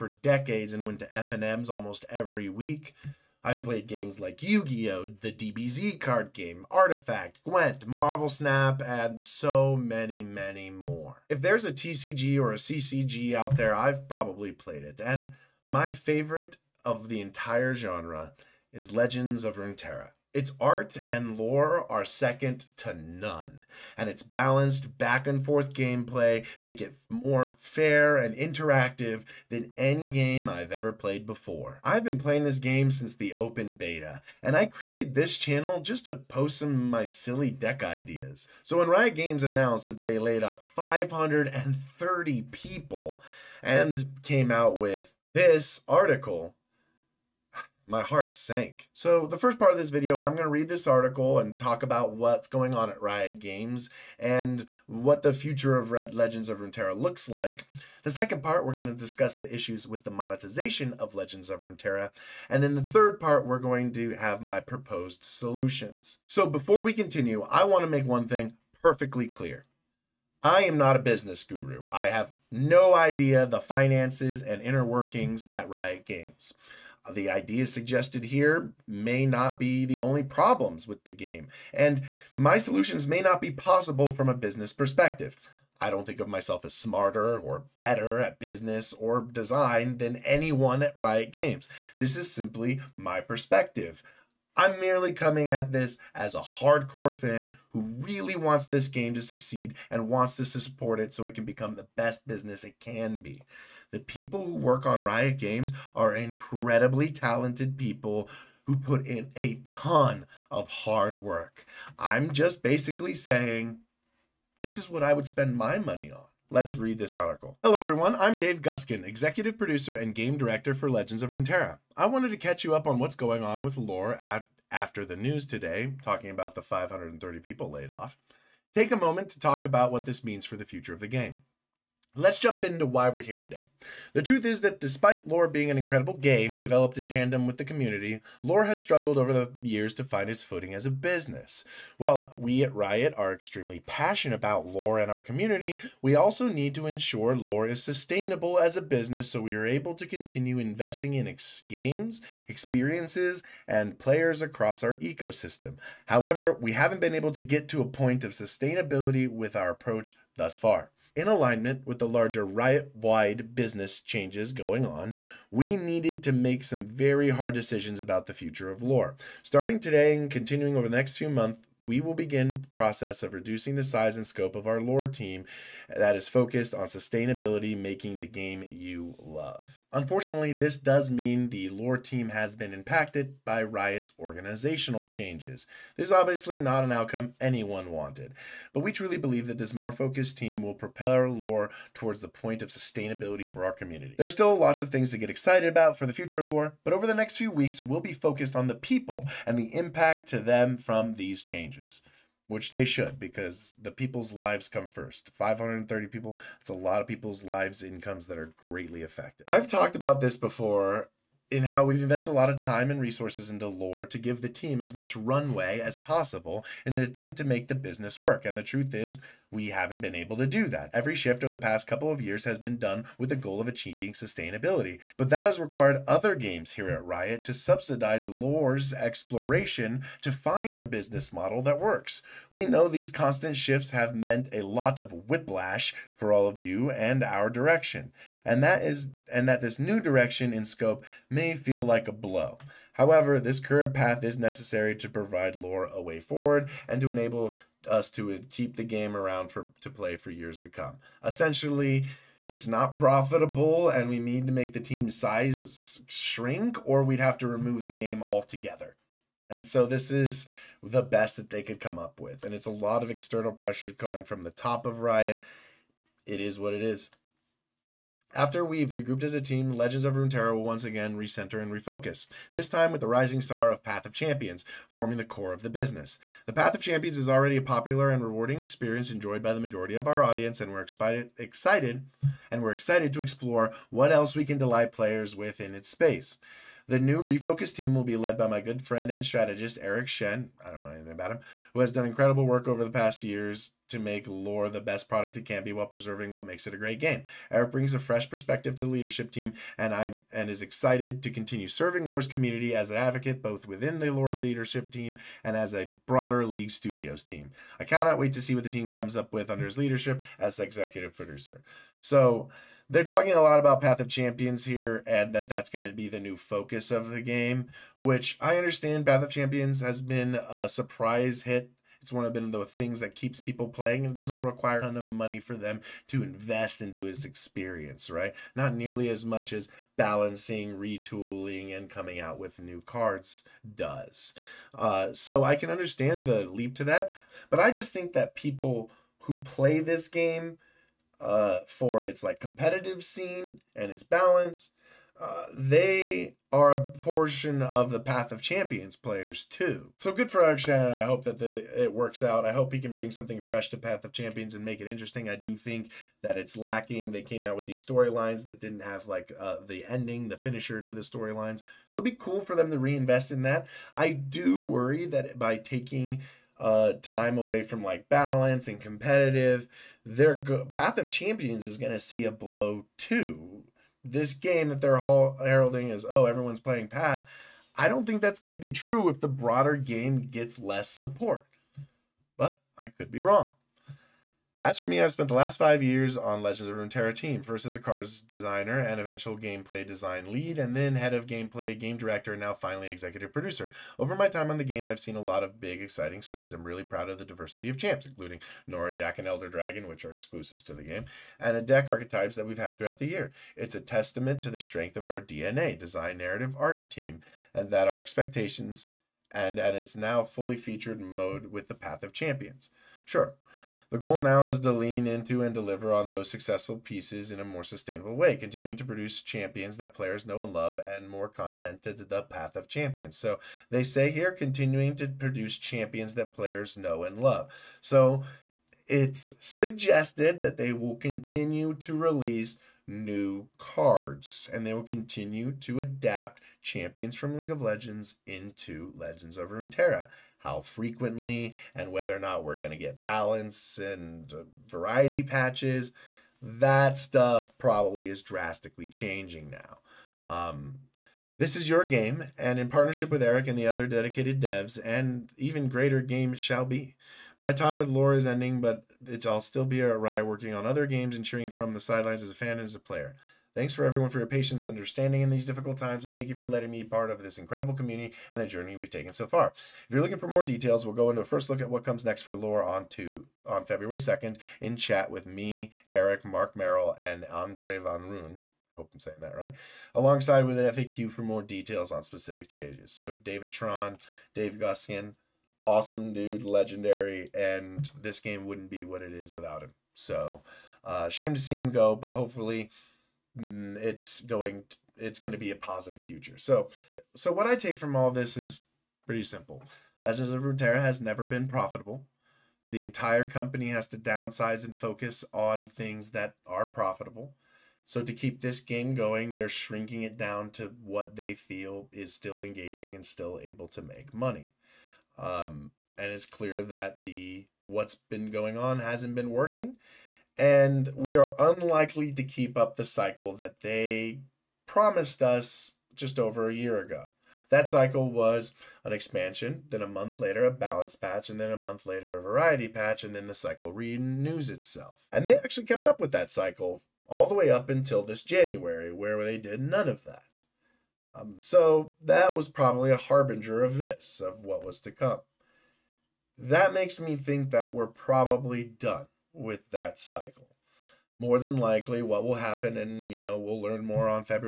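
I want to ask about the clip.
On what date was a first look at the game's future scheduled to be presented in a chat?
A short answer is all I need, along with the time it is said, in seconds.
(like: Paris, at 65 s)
February 2nd, at 473 s.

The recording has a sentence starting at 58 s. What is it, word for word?
The second part, we're going to discuss the issues with the monetization of Legends of Runeterra.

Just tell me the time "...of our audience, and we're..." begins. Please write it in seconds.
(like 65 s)
279 s.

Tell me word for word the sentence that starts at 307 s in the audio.
I cannot wait to see what the team comes up with under his leadership as executive producer.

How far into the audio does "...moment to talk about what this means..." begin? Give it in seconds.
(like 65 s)
128 s.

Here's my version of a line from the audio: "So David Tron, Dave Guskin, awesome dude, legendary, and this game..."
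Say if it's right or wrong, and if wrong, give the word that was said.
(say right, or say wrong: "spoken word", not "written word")
right.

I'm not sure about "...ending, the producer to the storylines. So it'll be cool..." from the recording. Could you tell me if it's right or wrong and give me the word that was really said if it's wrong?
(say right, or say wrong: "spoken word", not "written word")
wrong: "finisher", not "producer".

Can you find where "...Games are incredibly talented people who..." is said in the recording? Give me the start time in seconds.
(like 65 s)
105 s.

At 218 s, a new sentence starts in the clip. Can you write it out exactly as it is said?
And the truth is, we haven't been able to do that.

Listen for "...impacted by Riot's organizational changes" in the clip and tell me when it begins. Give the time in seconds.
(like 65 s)
182 s.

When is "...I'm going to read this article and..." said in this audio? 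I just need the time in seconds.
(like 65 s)
50 s.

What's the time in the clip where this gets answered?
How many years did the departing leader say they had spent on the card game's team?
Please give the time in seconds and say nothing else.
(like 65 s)
385 s.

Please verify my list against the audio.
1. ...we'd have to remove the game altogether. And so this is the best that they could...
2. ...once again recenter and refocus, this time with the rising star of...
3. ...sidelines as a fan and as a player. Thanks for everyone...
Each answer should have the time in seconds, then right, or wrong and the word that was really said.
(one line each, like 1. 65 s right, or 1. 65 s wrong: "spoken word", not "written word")
1. 257 s right
2. 270 s right
3. 461 s right.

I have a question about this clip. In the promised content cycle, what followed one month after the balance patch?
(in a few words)
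variety patch.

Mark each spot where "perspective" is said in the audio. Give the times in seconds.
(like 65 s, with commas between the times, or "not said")
84 s, 93 s, 298 s.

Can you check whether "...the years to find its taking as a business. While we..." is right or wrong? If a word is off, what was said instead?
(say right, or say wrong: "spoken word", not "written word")
wrong: "footing", not "taking".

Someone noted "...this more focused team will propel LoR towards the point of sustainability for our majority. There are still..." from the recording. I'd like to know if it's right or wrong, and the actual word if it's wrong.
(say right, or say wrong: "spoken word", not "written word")
wrong: "community", not "majority".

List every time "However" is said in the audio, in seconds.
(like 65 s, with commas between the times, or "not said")
156 s, 242 s.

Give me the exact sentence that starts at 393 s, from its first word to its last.
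Over my time on the game, I've seen a lot of big, exciting swings.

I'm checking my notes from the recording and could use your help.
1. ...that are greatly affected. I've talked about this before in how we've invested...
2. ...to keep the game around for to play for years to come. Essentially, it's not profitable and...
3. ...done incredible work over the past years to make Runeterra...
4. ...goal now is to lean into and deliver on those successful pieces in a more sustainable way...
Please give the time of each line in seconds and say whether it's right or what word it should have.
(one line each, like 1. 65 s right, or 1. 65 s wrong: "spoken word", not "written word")
1. 208 s right
2. 248 s right
3. 291 s wrong: "LoR", not "Runeterra"
4. 413 s right.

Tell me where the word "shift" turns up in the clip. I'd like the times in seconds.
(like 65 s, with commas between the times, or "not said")
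221 s, 233 s.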